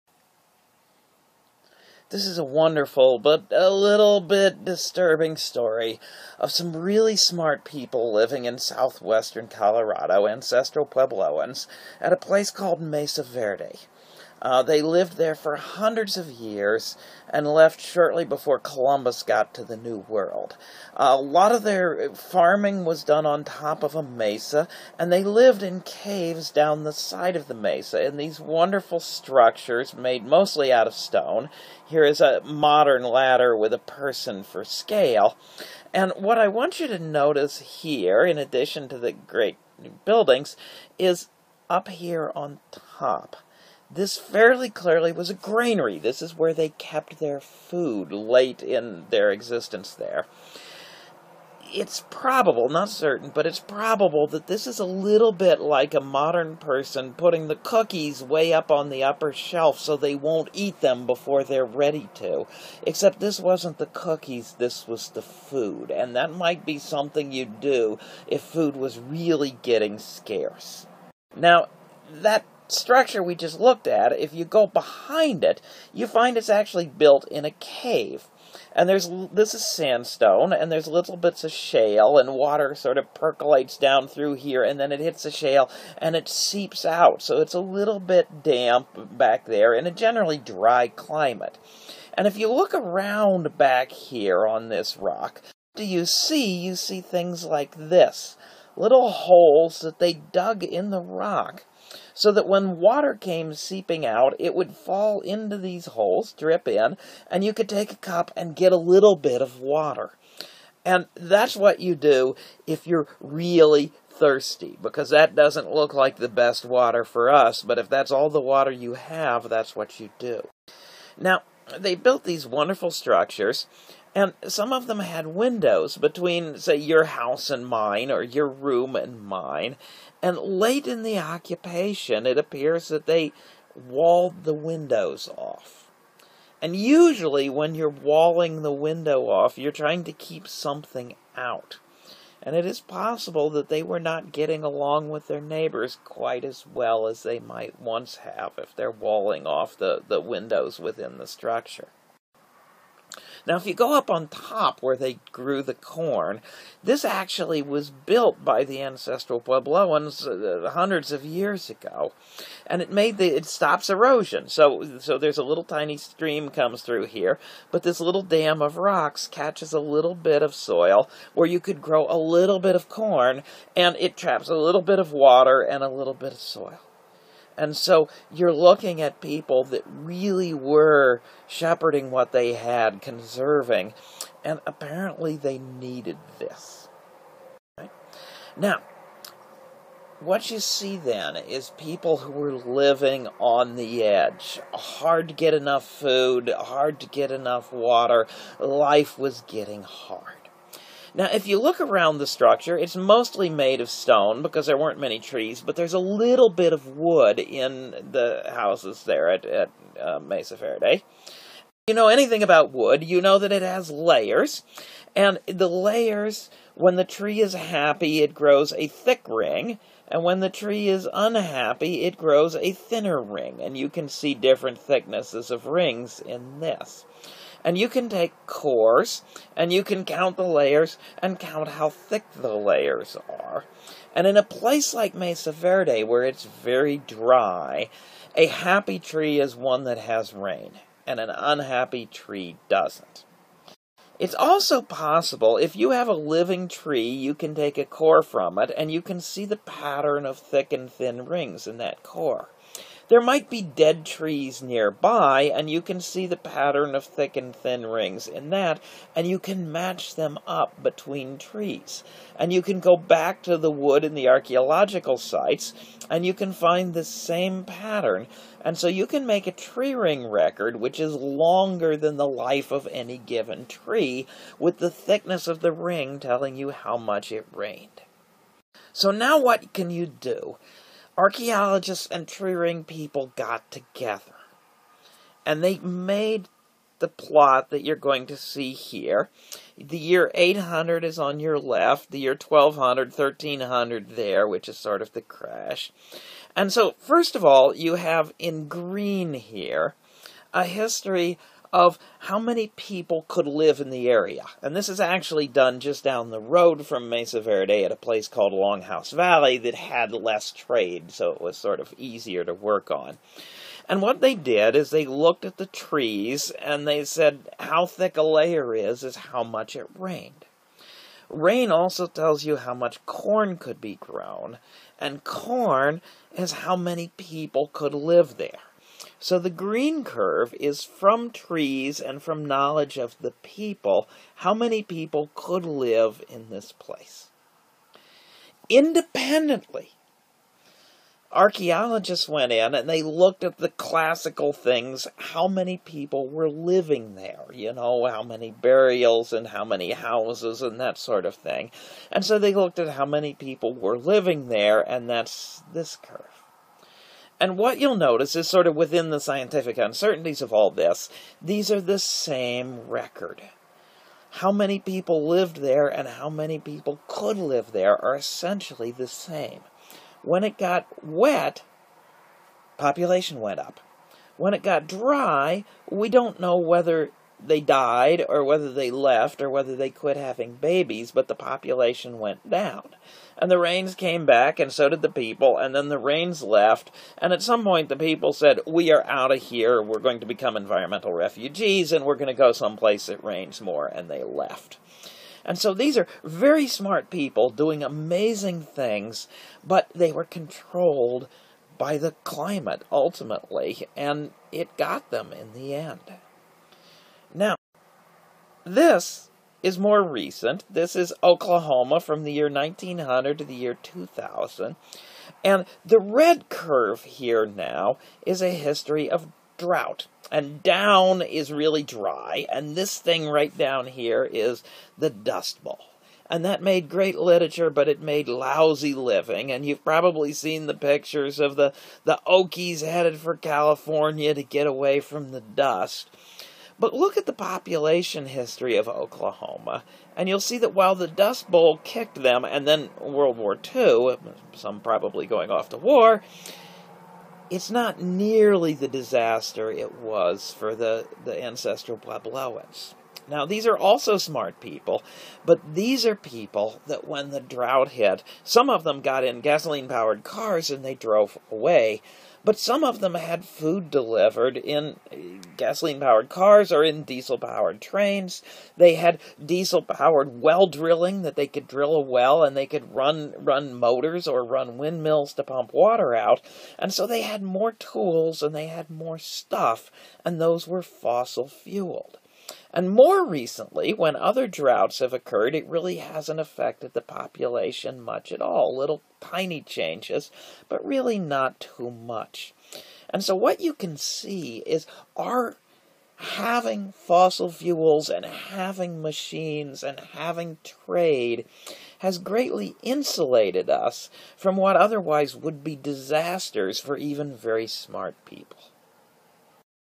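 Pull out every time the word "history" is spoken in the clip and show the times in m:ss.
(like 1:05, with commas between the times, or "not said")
5:00, 6:58, 7:18.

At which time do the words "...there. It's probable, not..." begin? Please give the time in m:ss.
0:49.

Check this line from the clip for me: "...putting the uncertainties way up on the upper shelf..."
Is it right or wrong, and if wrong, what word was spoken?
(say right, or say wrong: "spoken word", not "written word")
wrong: "cookies", not "uncertainties".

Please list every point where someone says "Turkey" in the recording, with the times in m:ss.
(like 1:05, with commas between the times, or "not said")
not said.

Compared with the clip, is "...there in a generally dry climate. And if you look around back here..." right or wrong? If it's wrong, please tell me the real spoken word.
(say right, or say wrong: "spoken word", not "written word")
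right.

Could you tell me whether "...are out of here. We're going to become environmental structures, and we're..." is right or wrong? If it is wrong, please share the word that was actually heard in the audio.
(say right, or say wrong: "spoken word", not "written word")
wrong: "refugees", not "structures".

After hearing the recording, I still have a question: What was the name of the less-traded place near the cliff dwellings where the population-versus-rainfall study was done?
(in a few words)
Longhouse Valley.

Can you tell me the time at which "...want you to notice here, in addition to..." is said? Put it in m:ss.
0:36.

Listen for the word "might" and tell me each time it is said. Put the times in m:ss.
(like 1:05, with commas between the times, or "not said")
1:06, 2:27, 4:13.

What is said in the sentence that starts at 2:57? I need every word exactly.
And so you're looking at people that really were shepherding what they had, conserving, and apparently they needed this.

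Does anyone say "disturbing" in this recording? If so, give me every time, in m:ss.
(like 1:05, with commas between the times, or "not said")
0:04.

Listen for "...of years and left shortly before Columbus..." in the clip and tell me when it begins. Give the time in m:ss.
0:16.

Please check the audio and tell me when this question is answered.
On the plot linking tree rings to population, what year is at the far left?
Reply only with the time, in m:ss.
4:50.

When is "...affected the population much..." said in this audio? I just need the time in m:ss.
8:06.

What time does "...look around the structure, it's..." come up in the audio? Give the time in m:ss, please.
3:21.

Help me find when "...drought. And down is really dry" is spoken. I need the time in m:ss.
6:59.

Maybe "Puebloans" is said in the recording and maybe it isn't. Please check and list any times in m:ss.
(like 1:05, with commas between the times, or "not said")
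0:10, 2:39, 7:31.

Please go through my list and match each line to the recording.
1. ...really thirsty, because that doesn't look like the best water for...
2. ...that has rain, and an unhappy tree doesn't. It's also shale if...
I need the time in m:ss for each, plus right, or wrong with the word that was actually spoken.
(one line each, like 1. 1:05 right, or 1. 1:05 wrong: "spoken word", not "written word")
1. 1:53 right
2. 3:59 wrong: "possible", not "shale".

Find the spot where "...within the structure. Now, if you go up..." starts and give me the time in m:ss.
2:30.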